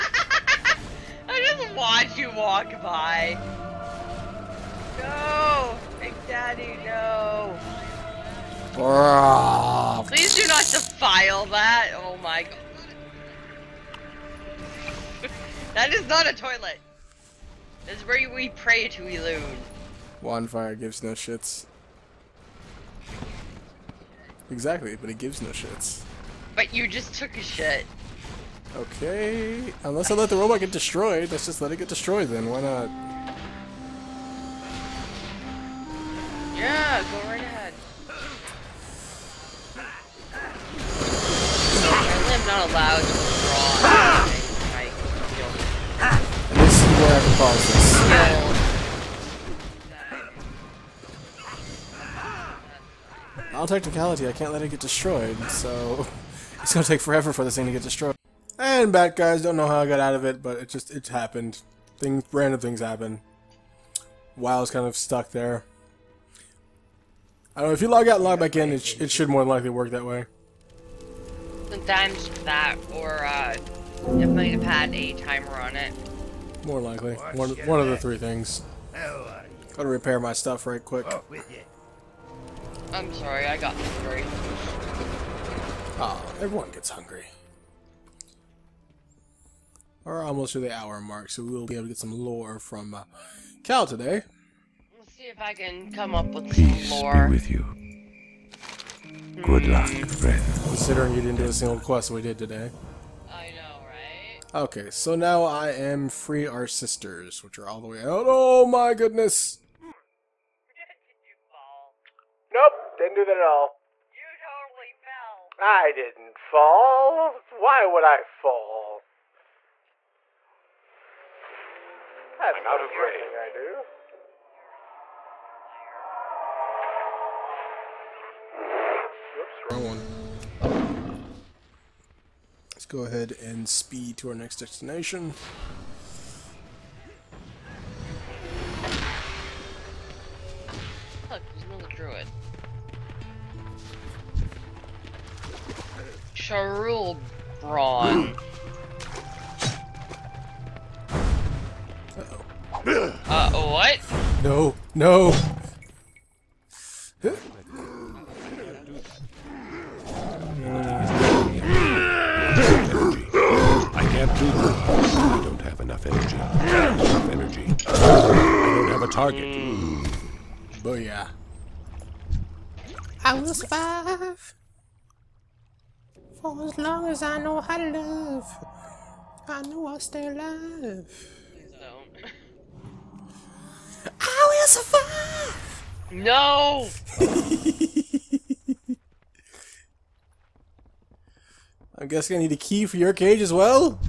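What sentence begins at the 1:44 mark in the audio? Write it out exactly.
Okay, so now I am free our sisters, which are all the way out.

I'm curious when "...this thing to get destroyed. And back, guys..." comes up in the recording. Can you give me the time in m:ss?
0:57.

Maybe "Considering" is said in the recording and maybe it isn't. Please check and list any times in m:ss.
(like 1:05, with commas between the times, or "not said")
1:40.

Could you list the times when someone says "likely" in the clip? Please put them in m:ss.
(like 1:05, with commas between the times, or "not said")
1:09, 1:16.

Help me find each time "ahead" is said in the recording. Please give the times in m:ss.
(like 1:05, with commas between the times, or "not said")
0:37, 2:13.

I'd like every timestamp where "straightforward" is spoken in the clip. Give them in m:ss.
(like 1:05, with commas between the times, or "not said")
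not said.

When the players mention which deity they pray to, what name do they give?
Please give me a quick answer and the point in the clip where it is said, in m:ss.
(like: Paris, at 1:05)
Elune, at 0:19.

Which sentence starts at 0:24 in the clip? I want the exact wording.
Exactly, but it gives no shits.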